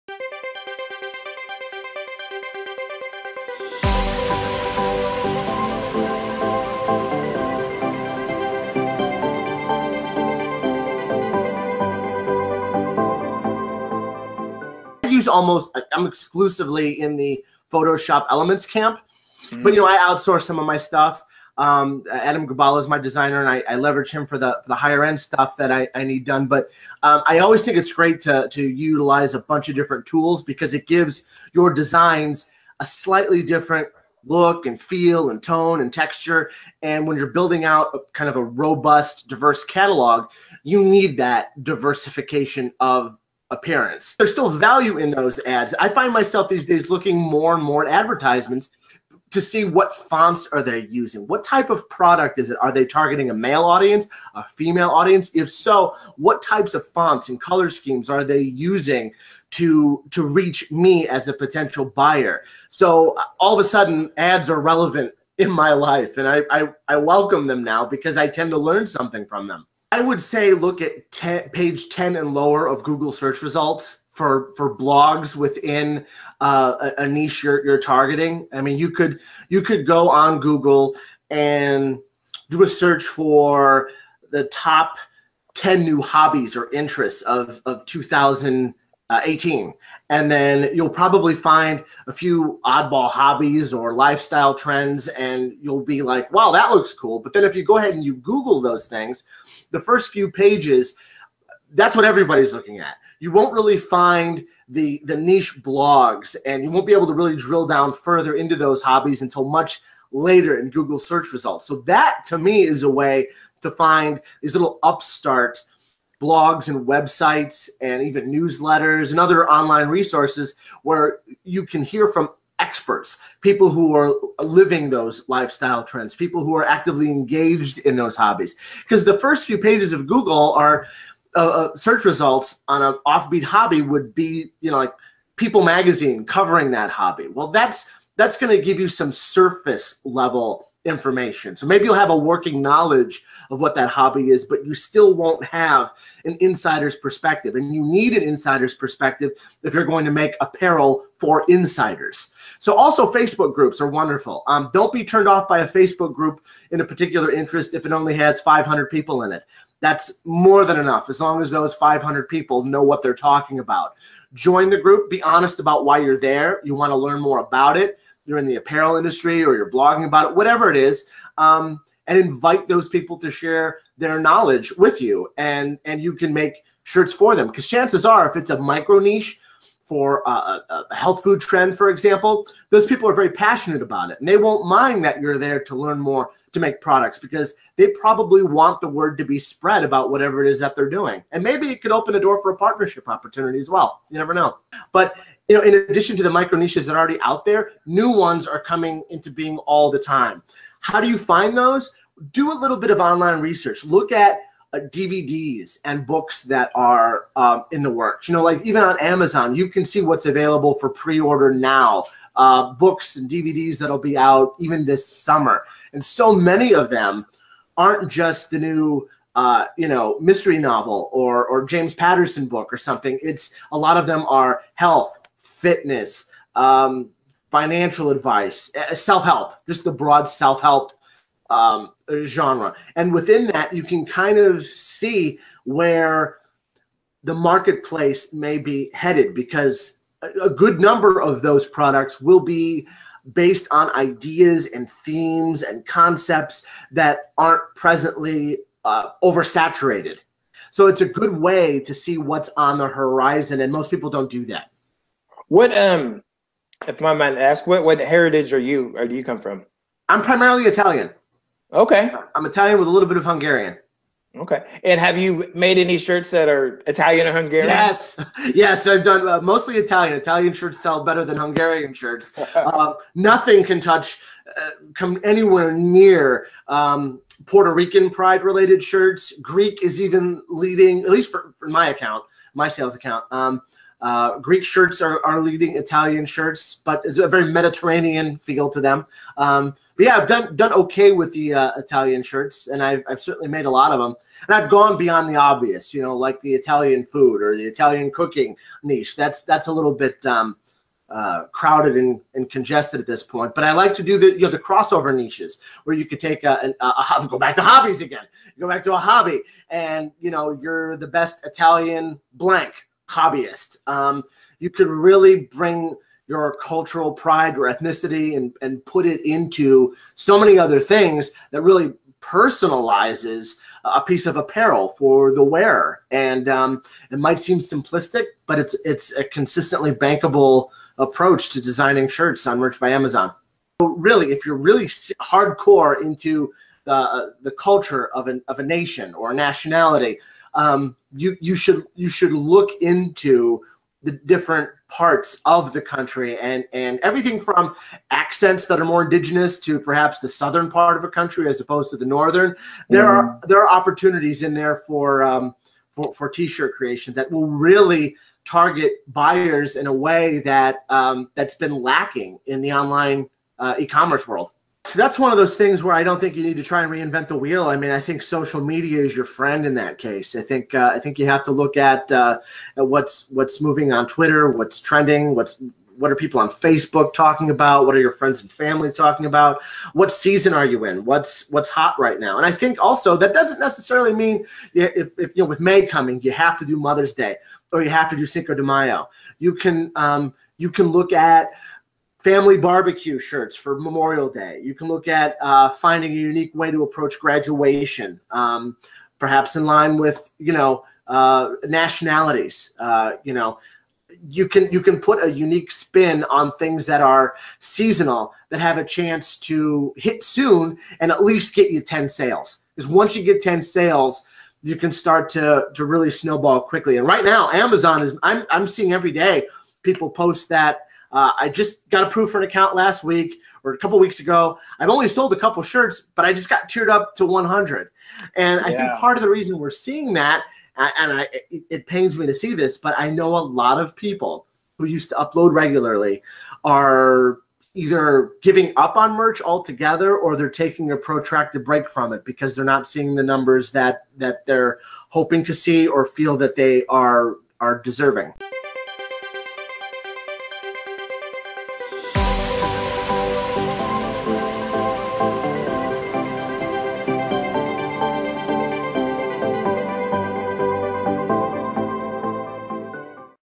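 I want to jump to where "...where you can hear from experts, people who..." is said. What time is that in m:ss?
2:00.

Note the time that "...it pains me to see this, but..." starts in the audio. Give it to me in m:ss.
7:11.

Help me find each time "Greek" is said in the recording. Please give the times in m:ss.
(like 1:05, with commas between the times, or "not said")
4:39, 4:44.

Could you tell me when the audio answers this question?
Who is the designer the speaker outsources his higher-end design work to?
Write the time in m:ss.
0:22.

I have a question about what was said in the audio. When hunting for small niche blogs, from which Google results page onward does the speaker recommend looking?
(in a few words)
Page 10.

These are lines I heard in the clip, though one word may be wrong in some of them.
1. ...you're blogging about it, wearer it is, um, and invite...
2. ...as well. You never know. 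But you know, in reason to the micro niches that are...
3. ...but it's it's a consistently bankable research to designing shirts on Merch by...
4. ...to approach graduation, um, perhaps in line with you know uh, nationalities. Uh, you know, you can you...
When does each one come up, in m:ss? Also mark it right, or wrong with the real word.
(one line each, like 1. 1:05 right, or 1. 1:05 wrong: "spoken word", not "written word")
1. 2:49 wrong: "whatever", not "wearer"
2. 3:13 wrong: "addition", not "reason"
3. 5:28 wrong: "approach", not "research"
4. 6:36 right.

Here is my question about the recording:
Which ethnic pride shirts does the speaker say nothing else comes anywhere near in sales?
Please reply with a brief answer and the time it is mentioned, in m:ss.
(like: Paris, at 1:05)
Puerto Rican, at 4:37.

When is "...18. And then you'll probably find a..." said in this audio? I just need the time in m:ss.
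1:29.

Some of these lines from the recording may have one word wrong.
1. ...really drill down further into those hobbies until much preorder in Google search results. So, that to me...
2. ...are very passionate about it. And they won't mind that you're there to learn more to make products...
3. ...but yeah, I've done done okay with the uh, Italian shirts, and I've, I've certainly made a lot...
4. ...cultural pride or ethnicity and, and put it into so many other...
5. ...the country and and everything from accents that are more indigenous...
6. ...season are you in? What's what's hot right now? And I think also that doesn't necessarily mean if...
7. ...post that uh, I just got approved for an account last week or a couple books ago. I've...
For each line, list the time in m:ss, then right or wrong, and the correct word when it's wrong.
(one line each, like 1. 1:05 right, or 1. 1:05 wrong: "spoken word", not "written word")
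1. 1:47 wrong: "later", not "preorder"
2. 3:03 right
3. 4:49 right
4. 5:16 right
5. 5:45 right
6. 6:20 right
7. 7:00 wrong: "weeks", not "books".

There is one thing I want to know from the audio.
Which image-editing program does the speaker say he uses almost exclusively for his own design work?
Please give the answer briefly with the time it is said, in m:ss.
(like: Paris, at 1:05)
Photoshop Elements, at 0:17.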